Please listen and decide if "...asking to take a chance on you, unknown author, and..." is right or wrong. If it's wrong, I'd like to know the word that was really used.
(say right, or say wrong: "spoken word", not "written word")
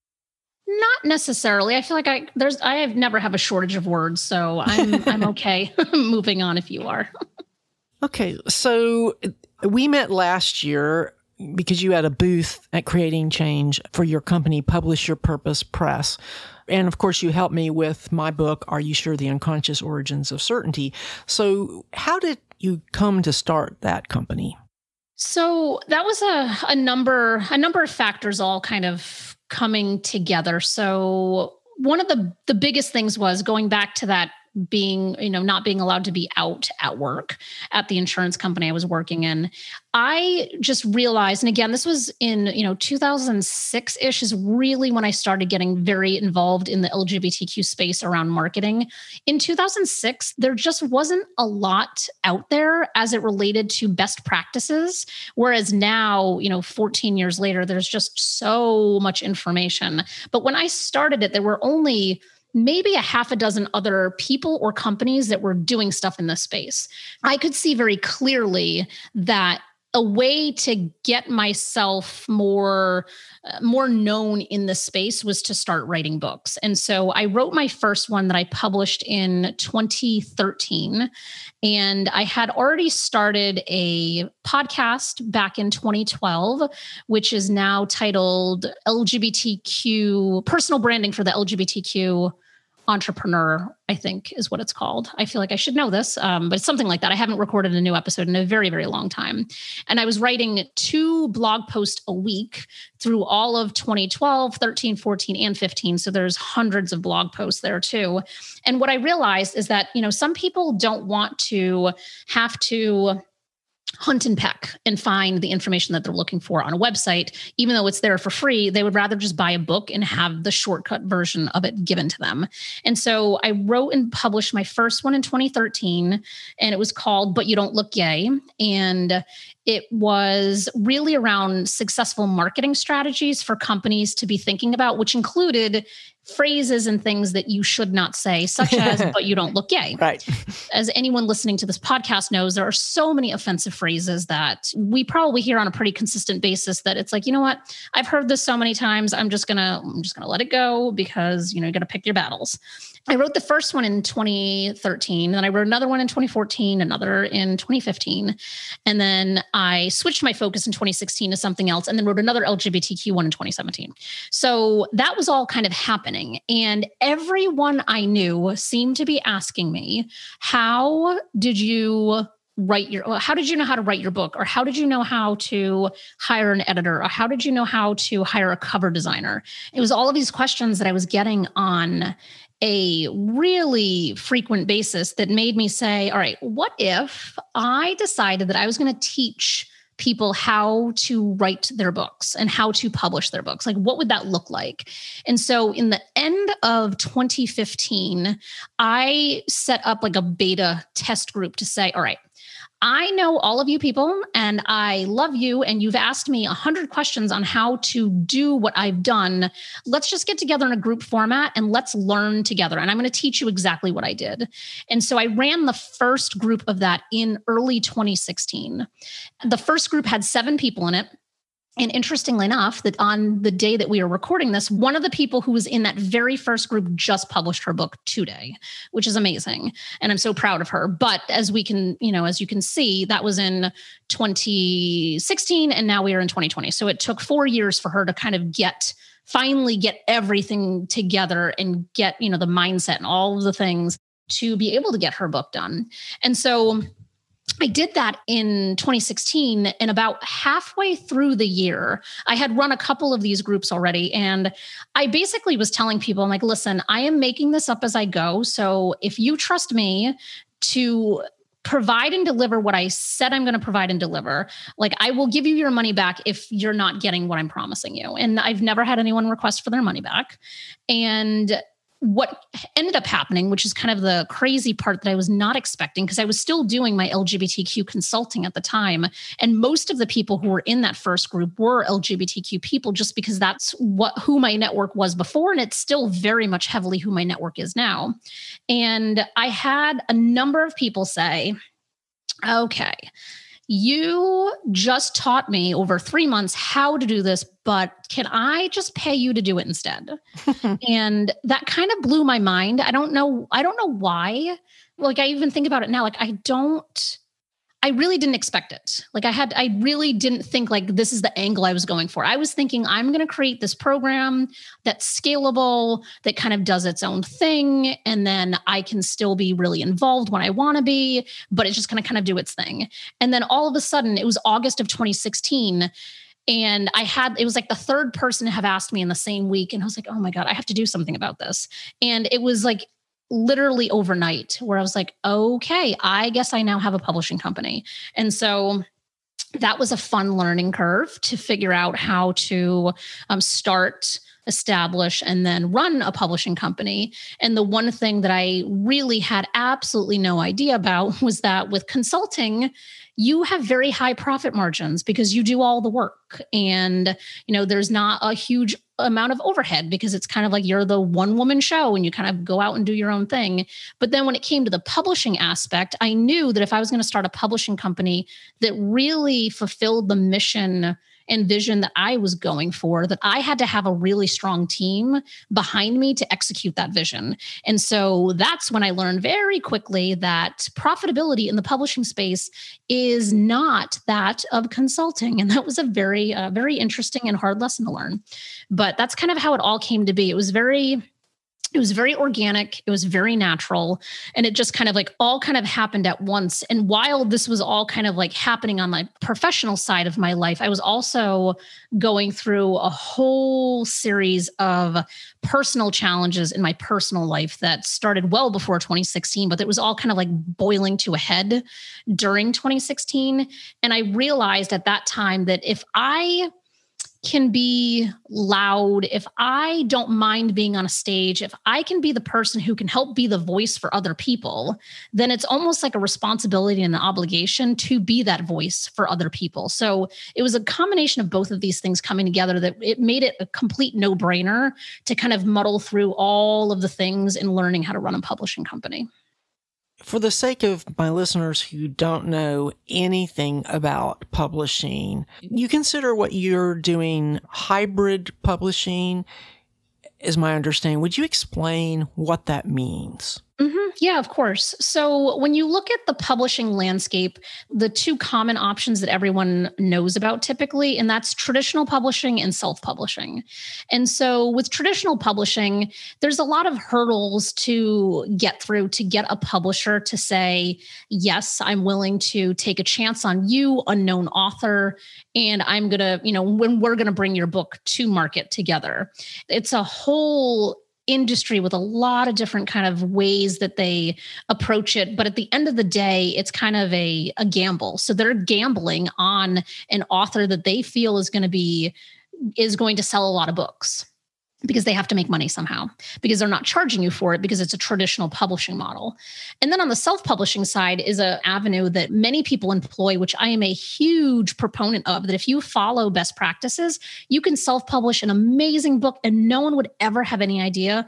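wrong: "willing", not "asking".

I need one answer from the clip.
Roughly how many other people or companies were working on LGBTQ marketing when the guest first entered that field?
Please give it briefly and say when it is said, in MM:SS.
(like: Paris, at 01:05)
half a dozen, at 01:03.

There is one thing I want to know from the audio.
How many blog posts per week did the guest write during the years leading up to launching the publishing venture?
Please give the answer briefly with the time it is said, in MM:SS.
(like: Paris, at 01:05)
2, at 01:40.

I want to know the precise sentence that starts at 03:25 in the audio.
And you've asked me a hundred questions on how to do what I've done.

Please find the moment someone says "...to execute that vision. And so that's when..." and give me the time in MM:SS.
06:16.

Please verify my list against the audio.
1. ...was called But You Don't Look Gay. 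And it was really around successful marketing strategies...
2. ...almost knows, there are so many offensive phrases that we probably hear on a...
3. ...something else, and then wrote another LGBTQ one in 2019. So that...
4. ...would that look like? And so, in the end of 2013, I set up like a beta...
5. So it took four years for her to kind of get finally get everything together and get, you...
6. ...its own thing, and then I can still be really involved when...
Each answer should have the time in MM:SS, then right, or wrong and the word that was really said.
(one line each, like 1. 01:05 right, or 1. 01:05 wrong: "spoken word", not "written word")
1. 02:06 right
2. 02:21 wrong: "podcast", not "almost"
3. 02:41 wrong: "2017", not "2019"
4. 03:13 wrong: "2015", not "2013"
5. 03:56 right
6. 05:16 right.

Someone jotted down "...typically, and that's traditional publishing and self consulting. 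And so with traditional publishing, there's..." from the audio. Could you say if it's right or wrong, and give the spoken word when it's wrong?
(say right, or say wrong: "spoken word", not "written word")
wrong: "publishing", not "consulting".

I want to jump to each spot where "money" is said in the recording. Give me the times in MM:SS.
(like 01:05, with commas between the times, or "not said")
04:25, 04:29, 08:15.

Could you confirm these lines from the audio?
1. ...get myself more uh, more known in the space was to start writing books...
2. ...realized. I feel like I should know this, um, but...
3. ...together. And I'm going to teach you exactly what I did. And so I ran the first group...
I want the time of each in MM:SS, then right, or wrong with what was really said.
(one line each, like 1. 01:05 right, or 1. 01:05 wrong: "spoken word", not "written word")
1. 01:11 right
2. 01:34 wrong: "called", not "realized"
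3. 03:32 right.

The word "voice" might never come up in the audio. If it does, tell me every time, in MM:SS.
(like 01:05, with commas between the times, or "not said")
07:03, 07:08.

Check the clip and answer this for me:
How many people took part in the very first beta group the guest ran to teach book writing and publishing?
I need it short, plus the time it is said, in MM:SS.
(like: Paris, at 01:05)
7, at 03:40.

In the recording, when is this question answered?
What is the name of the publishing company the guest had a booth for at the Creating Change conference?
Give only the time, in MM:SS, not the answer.
00:14.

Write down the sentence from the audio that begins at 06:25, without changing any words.
And that was a very, uh, very interesting and hard lesson to learn.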